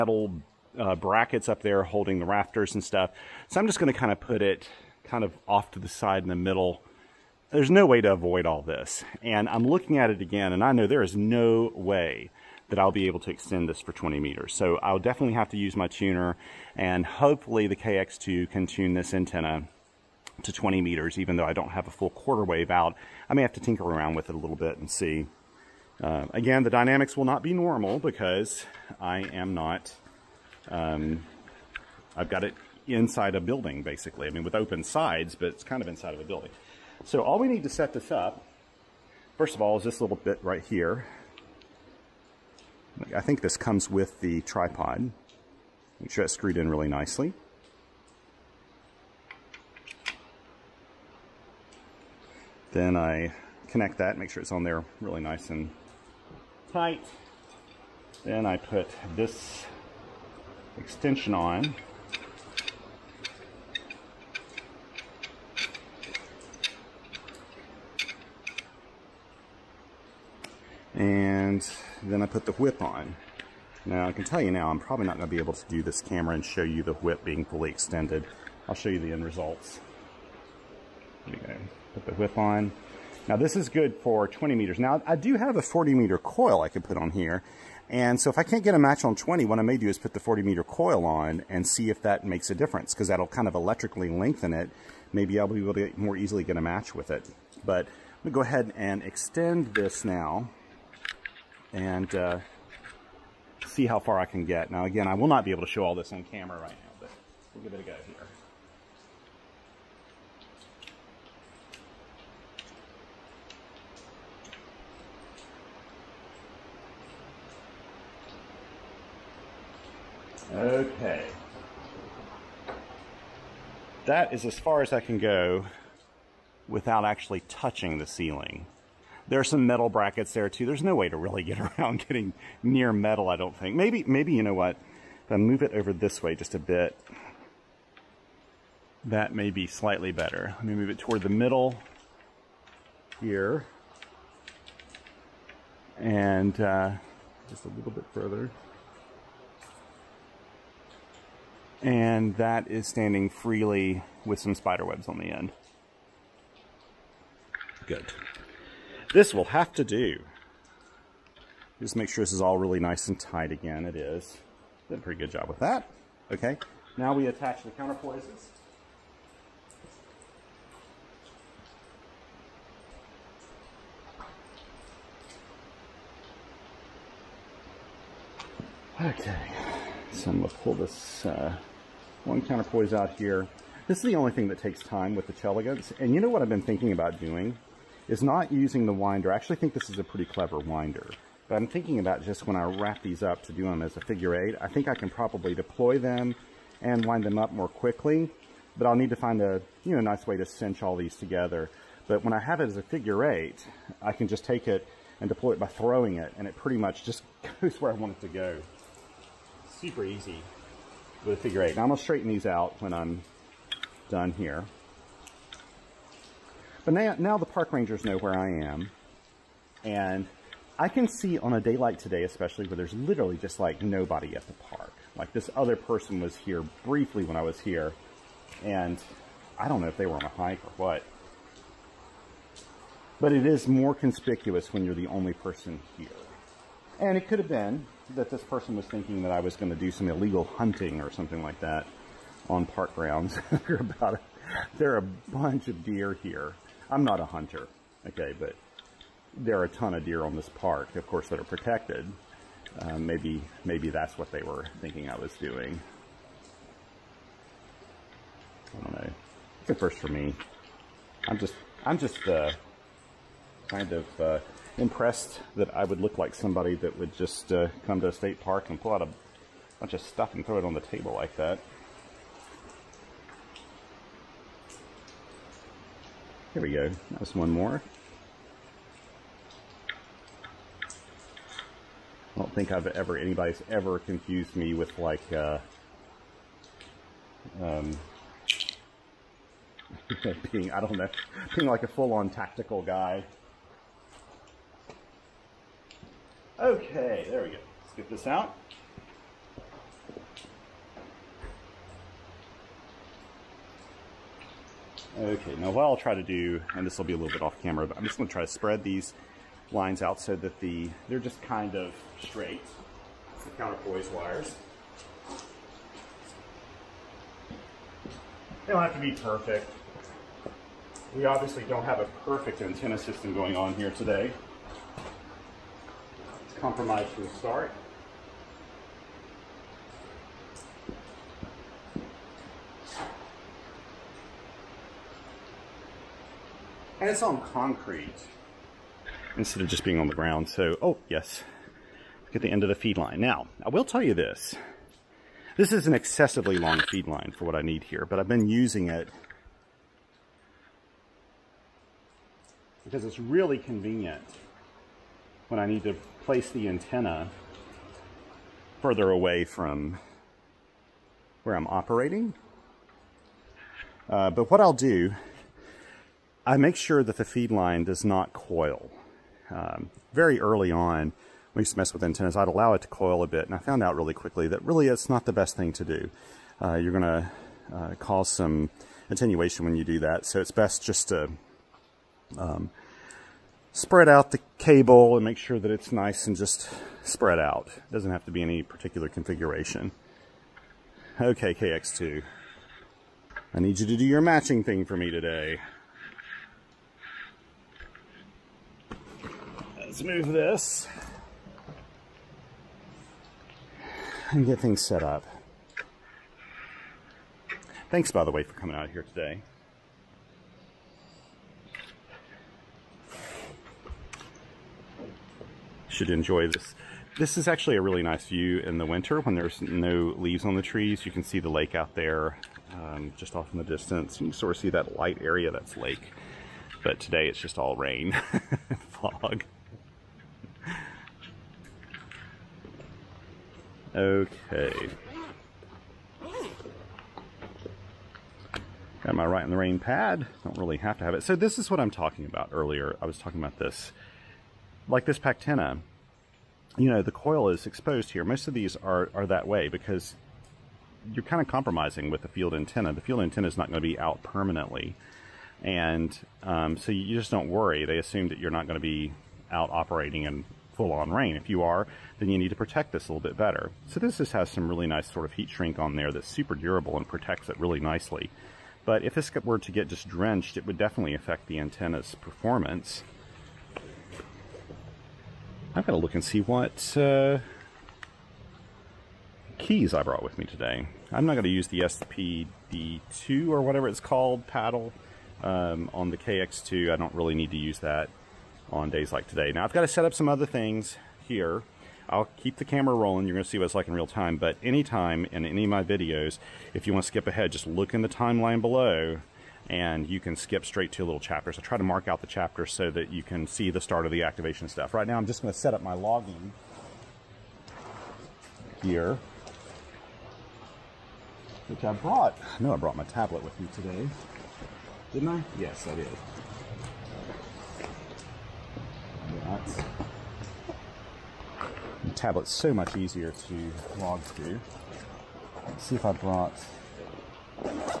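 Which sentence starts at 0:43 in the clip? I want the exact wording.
I think this comes with the tripod.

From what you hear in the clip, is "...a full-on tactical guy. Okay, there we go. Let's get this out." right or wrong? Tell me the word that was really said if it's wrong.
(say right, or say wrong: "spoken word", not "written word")
right.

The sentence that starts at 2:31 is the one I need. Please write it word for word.
And that is standing freely with some spider webs on the end.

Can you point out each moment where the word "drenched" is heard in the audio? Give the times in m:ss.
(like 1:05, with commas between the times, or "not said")
7:50.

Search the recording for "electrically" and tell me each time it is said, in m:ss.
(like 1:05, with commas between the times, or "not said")
1:33.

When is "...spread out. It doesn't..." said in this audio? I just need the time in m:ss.
6:27.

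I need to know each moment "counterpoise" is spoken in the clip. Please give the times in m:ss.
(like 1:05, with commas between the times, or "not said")
2:47, 3:02, 5:13.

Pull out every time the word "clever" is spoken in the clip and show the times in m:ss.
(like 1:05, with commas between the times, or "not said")
3:10.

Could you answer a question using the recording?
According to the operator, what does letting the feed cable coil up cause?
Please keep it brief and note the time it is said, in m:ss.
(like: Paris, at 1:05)
attenuation, at 6:19.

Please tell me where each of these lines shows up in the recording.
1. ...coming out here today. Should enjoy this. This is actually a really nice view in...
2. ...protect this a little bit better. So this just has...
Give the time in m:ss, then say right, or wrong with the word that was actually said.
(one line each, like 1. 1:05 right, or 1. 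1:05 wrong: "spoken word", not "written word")
1. 6:48 right
2. 7:42 right.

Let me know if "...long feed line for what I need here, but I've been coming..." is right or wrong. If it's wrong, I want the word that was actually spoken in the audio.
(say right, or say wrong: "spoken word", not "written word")
wrong: "using", not "coming".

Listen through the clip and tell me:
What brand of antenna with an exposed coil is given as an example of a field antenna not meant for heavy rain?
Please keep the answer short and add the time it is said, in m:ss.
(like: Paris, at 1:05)
PackTenna, at 7:25.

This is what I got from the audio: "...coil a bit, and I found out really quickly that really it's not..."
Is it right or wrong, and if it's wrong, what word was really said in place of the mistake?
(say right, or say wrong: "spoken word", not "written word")
right.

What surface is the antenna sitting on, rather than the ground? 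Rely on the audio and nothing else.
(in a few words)
concrete.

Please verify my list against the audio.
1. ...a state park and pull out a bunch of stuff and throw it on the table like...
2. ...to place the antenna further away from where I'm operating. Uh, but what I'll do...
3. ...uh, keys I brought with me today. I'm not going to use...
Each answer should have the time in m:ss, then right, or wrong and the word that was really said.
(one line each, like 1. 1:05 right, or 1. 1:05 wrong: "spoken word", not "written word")
1. 4:28 right
2. 5:55 right
3. 7:56 right.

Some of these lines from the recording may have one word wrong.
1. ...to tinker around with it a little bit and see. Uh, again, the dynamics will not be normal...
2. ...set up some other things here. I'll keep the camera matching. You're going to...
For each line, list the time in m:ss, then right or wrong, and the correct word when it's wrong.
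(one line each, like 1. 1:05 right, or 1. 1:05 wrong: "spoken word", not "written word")
1. 0:23 right
2. 8:09 wrong: "rolling", not "matching".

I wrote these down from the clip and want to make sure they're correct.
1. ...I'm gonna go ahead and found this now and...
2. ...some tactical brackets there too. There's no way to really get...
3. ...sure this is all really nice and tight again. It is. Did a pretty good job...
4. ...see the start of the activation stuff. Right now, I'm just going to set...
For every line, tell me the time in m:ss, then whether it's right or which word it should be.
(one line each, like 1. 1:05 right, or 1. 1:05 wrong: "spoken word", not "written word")
1. 1:37 wrong: "extend", not "found"
2. 2:09 wrong: "metal", not "tactical"
3. 2:42 right
4. 8:23 right.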